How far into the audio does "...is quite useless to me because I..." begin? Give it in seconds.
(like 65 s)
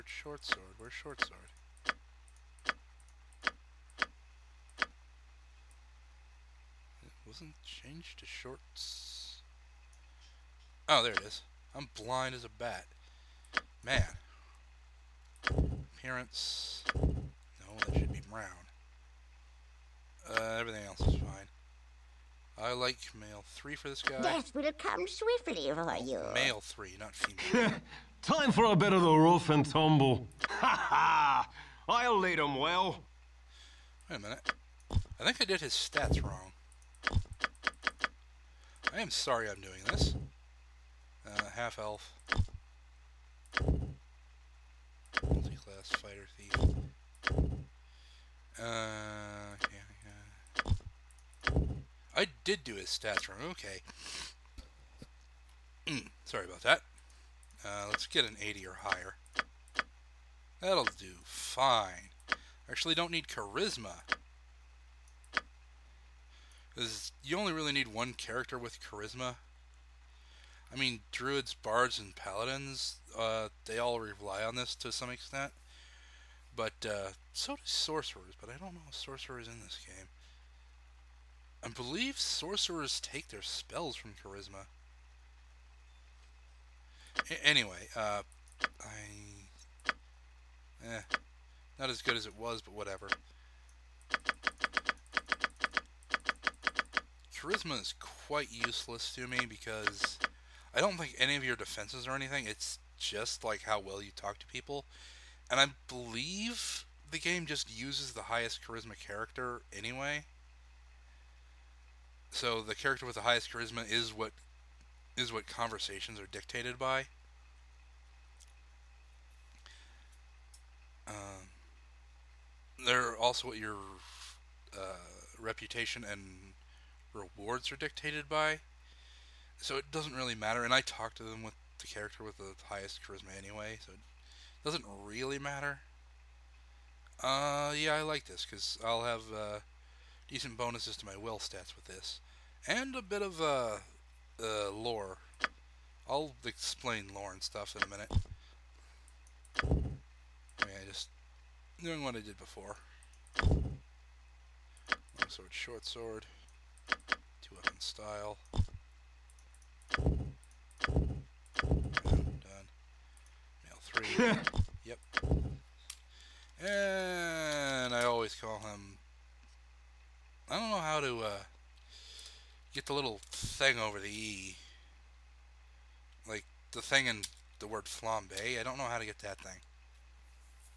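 97 s.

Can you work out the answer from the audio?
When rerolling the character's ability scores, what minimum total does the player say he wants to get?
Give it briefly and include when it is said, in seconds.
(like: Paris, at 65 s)
80, at 58 s.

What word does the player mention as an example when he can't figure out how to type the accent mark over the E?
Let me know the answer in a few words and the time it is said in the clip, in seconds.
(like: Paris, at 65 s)
Flambe, at 177 s.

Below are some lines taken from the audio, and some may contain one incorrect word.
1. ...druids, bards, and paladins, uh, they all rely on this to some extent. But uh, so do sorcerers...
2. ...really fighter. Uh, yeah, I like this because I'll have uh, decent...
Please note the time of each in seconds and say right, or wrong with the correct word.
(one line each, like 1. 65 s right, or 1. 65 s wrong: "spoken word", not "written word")
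1. 71 s right
2. 135 s wrong: "matter", not "fighter".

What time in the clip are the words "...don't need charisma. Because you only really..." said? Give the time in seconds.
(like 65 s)
62 s.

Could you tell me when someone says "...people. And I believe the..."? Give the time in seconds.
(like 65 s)
104 s.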